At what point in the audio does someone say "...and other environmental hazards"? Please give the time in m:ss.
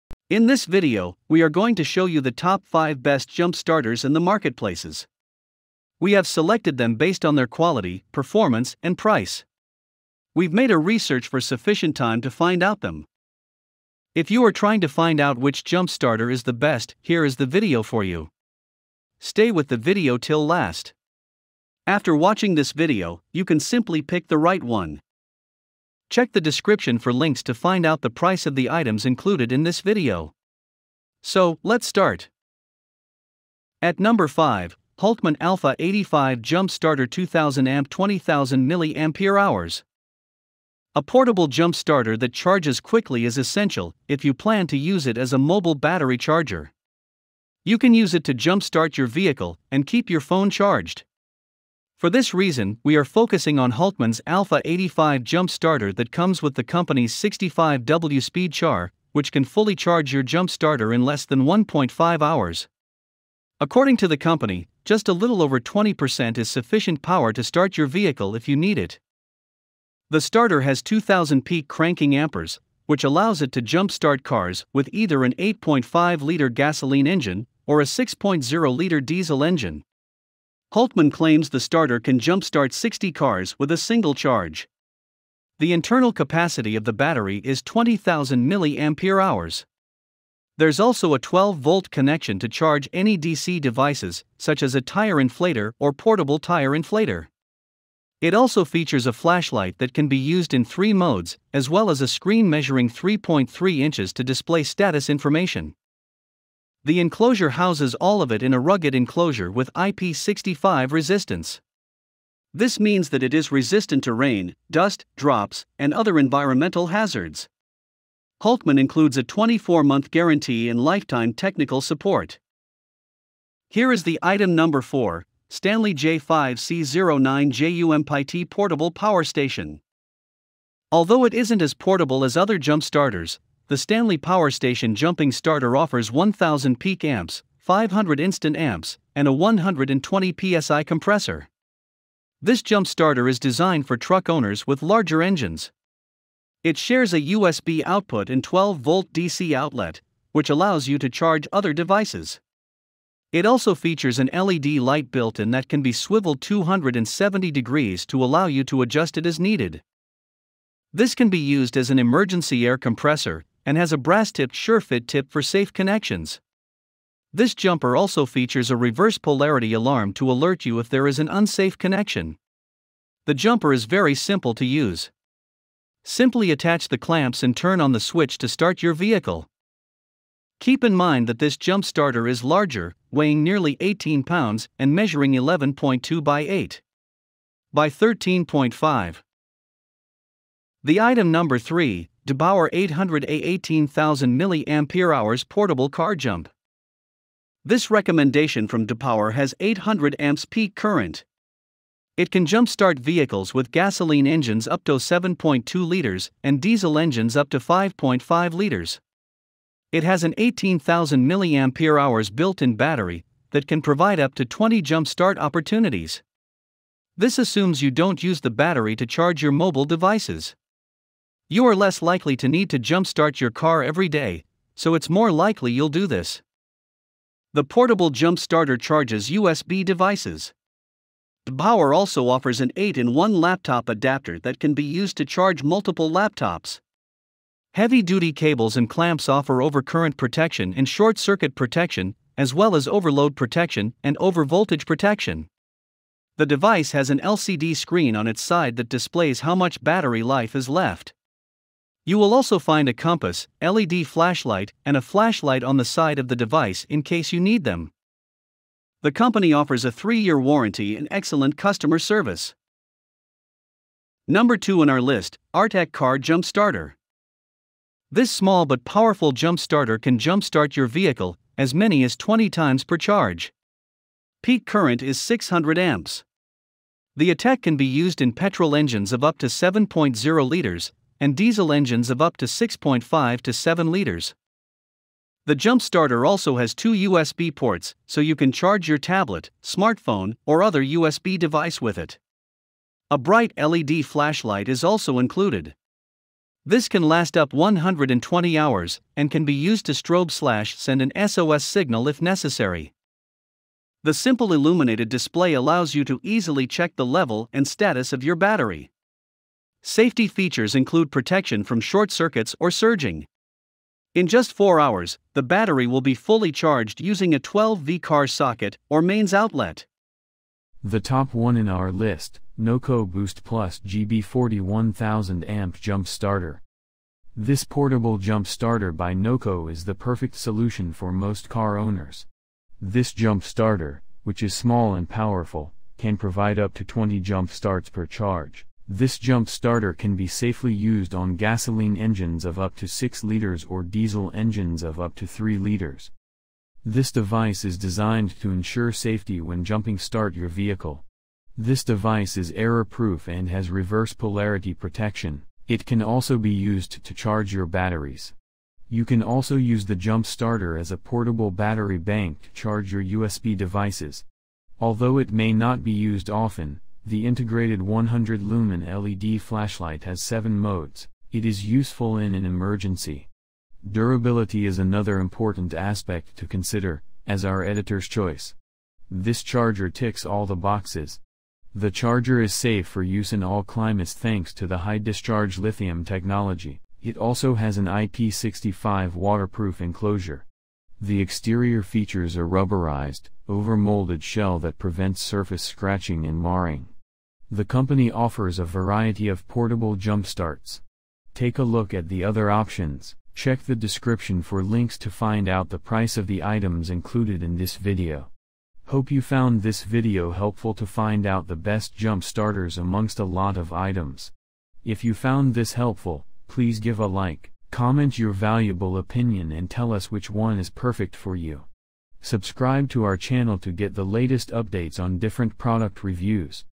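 1:55.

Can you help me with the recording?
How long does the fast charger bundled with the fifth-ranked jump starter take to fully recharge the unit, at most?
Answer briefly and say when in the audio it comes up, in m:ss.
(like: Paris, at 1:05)
1.5 hours, at 1:01.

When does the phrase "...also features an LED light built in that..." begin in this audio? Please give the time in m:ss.
2:33.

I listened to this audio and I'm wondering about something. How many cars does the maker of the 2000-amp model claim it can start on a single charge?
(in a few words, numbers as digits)
60.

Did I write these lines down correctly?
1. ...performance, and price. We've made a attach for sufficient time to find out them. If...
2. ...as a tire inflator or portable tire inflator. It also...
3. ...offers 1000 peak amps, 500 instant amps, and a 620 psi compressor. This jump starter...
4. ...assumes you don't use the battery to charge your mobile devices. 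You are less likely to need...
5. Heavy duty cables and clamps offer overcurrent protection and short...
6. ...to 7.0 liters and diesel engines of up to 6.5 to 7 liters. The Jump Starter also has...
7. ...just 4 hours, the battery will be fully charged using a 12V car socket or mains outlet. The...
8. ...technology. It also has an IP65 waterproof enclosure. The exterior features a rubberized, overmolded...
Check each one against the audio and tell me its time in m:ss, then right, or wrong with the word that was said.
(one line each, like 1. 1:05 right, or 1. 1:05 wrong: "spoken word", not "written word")
1. 0:08 wrong: "research", not "attach"
2. 1:34 right
3. 2:15 wrong: "120", not "620"
4. 3:37 right
5. 3:57 right
6. 4:39 right
7. 5:14 right
8. 6:26 right.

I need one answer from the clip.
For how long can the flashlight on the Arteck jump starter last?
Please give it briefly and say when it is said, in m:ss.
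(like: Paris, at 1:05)
120 hours, at 4:57.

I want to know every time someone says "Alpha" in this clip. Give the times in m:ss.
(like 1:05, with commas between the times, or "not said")
0:35, 0:54.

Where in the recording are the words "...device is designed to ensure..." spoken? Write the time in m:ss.
5:47.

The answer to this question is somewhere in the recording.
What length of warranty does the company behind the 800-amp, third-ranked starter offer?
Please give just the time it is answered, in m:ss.
4:19.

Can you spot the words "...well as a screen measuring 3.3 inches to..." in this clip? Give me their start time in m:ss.
1:41.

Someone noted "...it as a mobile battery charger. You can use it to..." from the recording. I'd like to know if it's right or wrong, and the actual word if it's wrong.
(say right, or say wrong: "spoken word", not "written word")
right.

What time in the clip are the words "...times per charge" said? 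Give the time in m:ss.
4:32.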